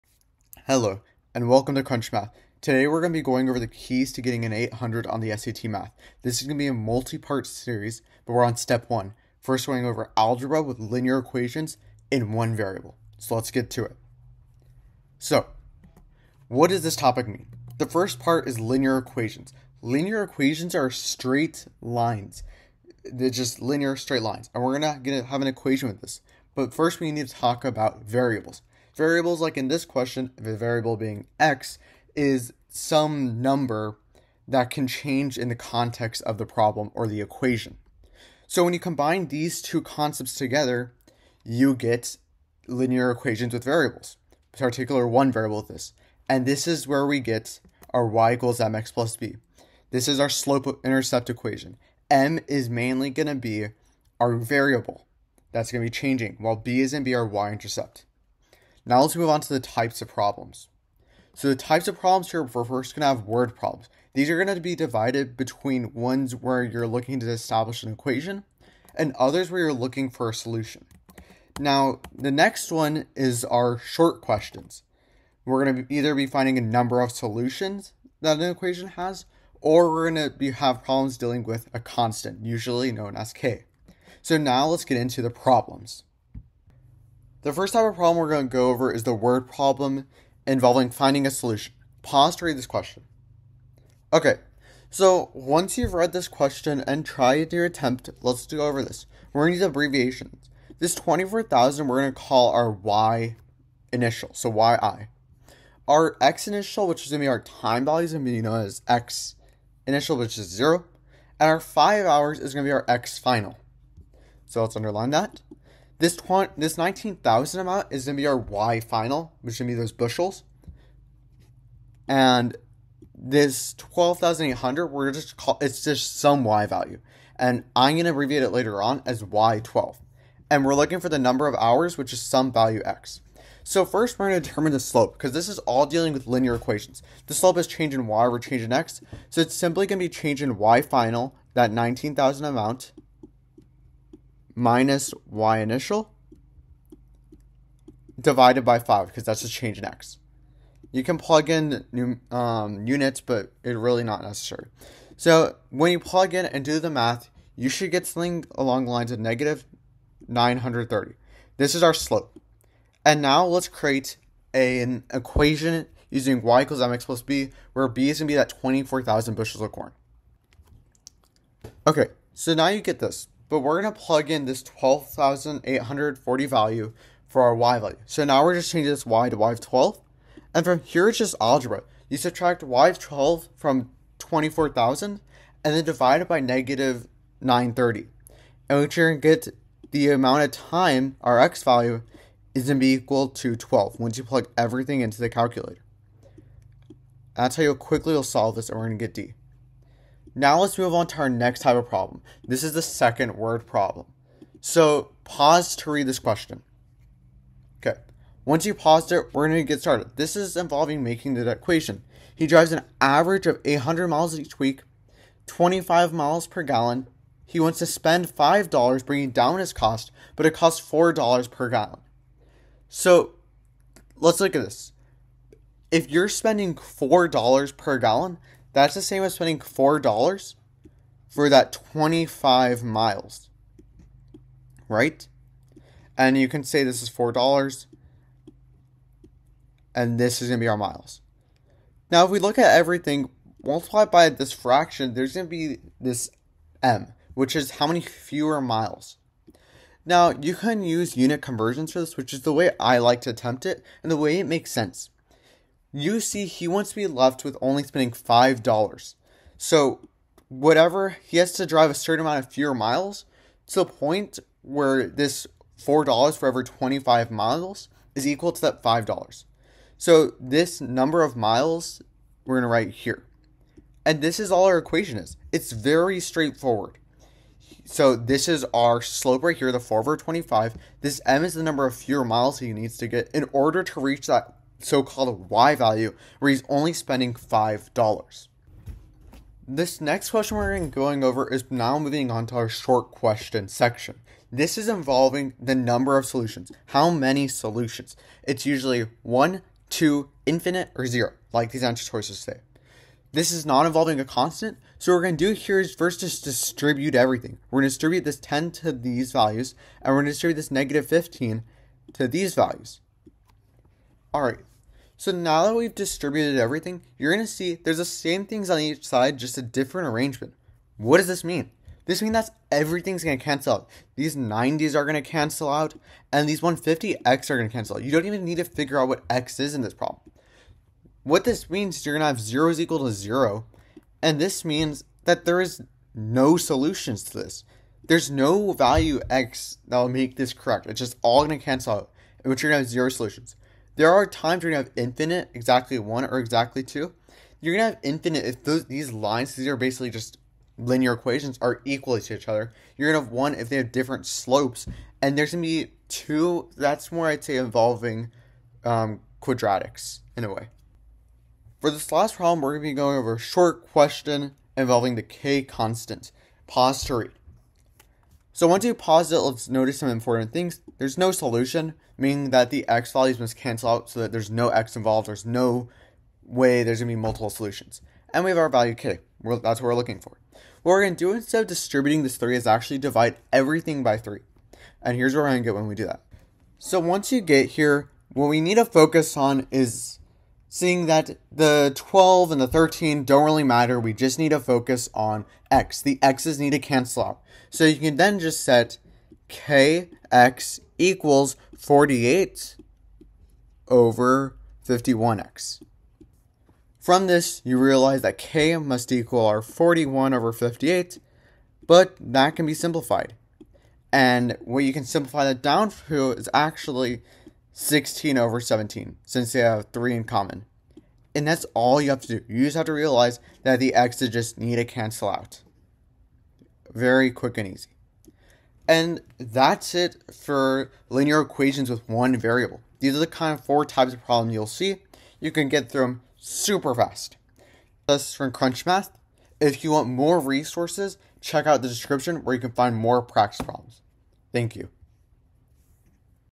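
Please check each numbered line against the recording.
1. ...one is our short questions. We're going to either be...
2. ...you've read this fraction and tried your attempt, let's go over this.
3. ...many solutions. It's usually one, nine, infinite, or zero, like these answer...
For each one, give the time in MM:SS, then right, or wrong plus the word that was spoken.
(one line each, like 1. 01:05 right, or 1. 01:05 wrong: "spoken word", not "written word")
1. 01:12 right
2. 01:35 wrong: "question", not "fraction"
3. 04:57 wrong: "two", not "nine".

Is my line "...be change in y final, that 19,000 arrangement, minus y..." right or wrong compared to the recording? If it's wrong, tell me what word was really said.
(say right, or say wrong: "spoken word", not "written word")
wrong: "amount", not "arrangement".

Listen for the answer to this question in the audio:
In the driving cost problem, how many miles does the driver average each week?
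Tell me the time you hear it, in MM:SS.
03:33.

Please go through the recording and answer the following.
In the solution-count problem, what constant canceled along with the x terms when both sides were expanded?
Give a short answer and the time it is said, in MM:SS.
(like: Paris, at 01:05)
90, at 05:24.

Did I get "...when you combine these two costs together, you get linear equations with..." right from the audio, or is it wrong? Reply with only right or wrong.
wrong.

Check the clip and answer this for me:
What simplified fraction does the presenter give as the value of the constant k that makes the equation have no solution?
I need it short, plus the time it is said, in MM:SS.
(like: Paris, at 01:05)
16/17, at 06:57.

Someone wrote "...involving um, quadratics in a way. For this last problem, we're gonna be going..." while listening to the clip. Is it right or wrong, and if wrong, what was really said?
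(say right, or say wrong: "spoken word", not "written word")
right.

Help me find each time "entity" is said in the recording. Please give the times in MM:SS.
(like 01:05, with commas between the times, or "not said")
not said.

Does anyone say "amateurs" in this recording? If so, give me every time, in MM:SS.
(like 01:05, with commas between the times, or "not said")
not said.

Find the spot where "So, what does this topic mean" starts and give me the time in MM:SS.
00:15.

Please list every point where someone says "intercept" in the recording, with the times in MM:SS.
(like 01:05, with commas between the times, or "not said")
00:50, 00:57.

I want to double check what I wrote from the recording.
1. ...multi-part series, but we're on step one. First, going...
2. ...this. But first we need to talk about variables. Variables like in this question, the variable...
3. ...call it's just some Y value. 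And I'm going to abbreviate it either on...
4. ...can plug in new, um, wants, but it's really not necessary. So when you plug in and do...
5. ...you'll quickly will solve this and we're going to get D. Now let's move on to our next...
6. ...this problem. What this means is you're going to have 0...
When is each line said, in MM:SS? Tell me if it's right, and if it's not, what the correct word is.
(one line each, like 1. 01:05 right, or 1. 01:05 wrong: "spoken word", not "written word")
1. 00:06 right
2. 00:26 right
3. 02:05 wrong: "later", not "either"
4. 02:31 wrong: "units", not "wants"
5. 03:17 right
6. 05:29 right.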